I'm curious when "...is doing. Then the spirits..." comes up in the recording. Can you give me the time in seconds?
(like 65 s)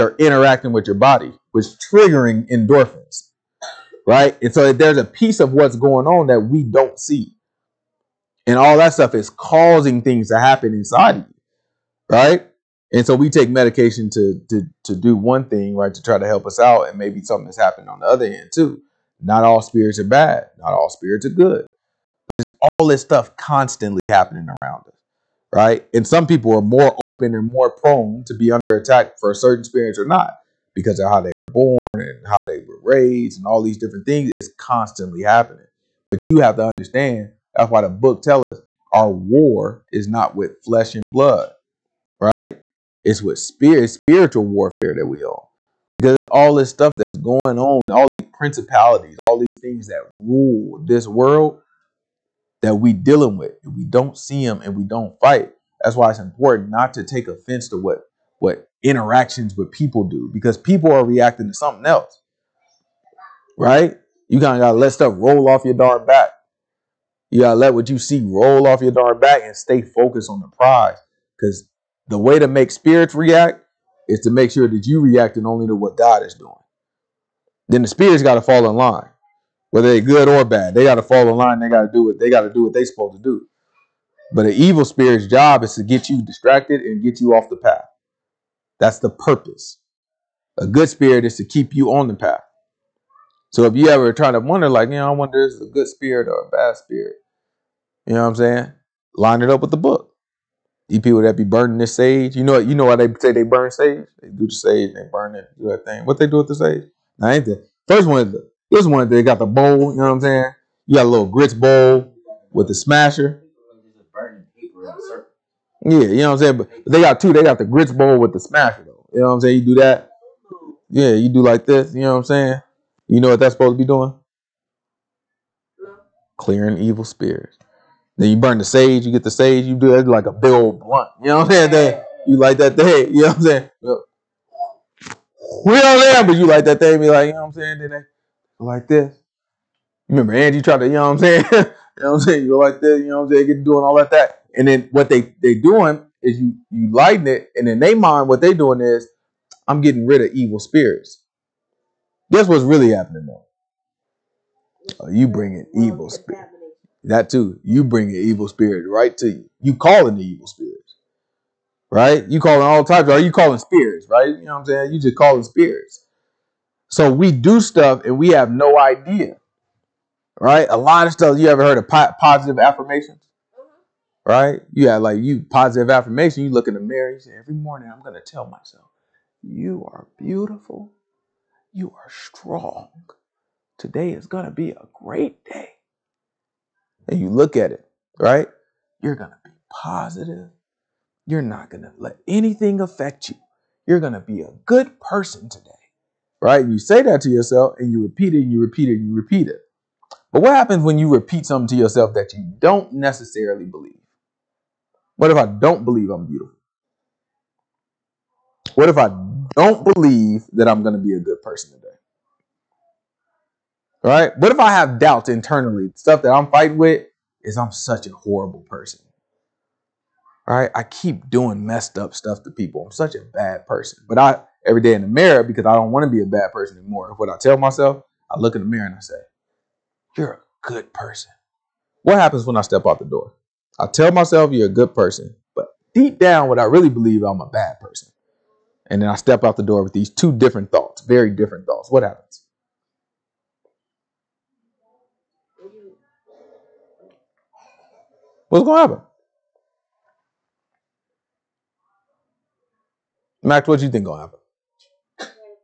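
76 s.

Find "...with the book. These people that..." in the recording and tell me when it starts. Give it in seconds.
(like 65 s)
99 s.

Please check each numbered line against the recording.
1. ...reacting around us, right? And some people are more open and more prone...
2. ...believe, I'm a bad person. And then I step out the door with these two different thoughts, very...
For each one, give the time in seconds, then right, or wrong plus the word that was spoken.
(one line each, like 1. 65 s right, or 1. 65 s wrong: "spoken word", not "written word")
1. 24 s wrong: "happening", not "reacting"
2. 236 s right.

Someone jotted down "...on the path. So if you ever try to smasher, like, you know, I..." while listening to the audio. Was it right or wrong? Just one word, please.
wrong.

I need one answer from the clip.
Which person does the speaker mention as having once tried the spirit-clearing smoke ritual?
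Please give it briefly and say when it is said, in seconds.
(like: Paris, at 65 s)
Angie, at 140 s.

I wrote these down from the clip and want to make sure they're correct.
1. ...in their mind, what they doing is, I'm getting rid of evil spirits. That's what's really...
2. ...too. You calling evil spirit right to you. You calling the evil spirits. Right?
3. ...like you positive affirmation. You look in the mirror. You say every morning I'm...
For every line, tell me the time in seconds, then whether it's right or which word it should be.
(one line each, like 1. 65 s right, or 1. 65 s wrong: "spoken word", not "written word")
1. 147 s right
2. 157 s wrong: "bringing", not "calling"
3. 175 s right.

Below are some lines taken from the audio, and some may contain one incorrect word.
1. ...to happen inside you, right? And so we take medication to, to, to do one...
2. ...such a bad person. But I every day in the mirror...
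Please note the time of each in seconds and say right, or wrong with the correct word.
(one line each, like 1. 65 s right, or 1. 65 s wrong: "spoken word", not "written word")
1. 10 s right
2. 222 s right.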